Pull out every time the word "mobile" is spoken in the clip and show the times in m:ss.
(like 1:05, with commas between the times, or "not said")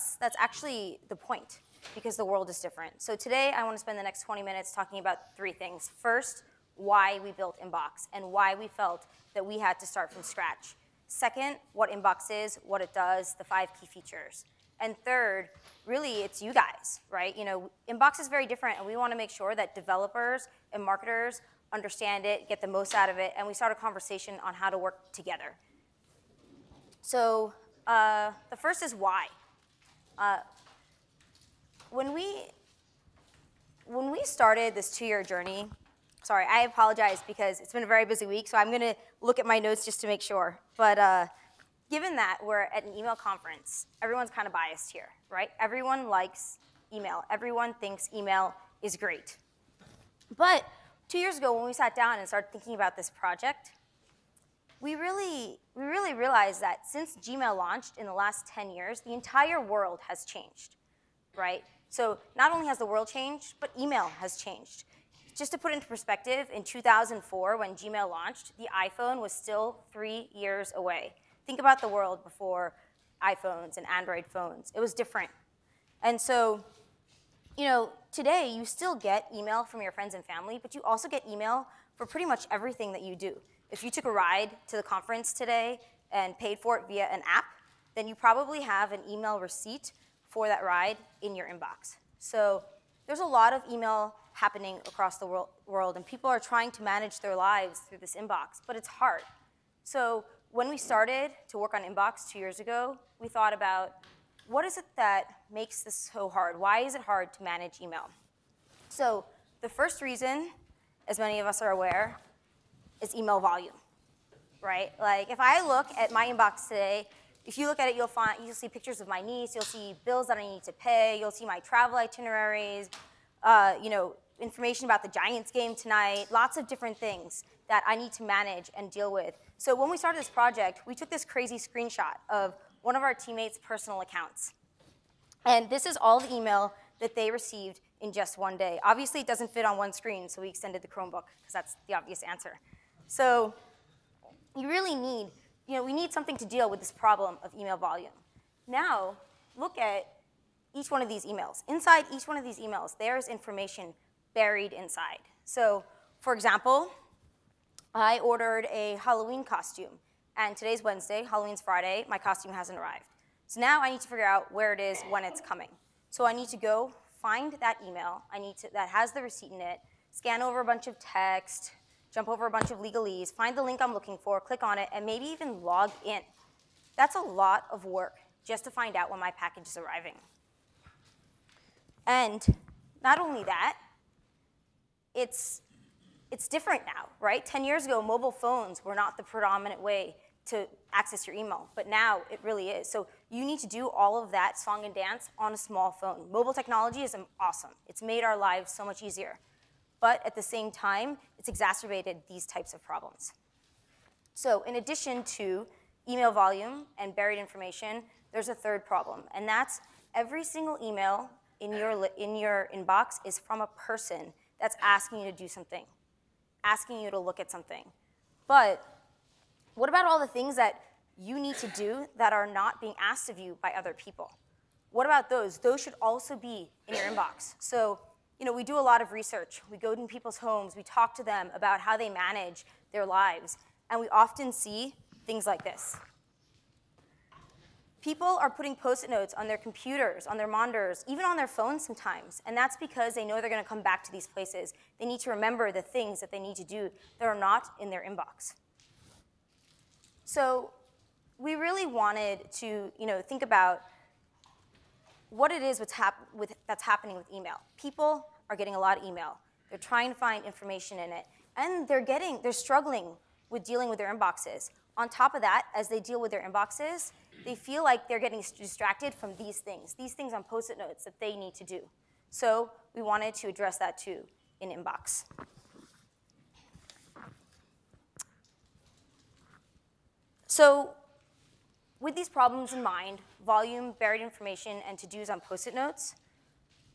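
3:08, 3:16.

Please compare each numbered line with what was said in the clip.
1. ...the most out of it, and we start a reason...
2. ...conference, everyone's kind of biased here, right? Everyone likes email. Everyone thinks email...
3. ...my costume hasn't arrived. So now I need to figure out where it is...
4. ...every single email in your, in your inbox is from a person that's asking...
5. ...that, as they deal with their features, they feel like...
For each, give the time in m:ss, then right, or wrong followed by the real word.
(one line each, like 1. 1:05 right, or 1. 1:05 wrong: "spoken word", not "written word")
1. 0:22 wrong: "conversation", not "reason"
2. 0:43 right
3. 2:42 right
4. 3:30 right
5. 4:25 wrong: "inboxes", not "features".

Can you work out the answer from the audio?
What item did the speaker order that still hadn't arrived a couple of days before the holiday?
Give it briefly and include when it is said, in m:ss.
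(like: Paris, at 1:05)
Halloween costume, at 2:39.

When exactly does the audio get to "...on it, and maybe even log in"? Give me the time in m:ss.
2:54.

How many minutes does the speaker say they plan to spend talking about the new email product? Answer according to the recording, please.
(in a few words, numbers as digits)
20.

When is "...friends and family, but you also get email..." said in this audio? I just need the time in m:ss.
1:19.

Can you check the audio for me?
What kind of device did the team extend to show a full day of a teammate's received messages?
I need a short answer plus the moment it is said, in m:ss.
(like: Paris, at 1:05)
Chromebook, at 2:20.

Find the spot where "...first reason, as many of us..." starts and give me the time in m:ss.
1:49.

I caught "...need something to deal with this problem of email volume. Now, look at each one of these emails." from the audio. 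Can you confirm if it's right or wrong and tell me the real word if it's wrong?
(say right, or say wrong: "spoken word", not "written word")
right.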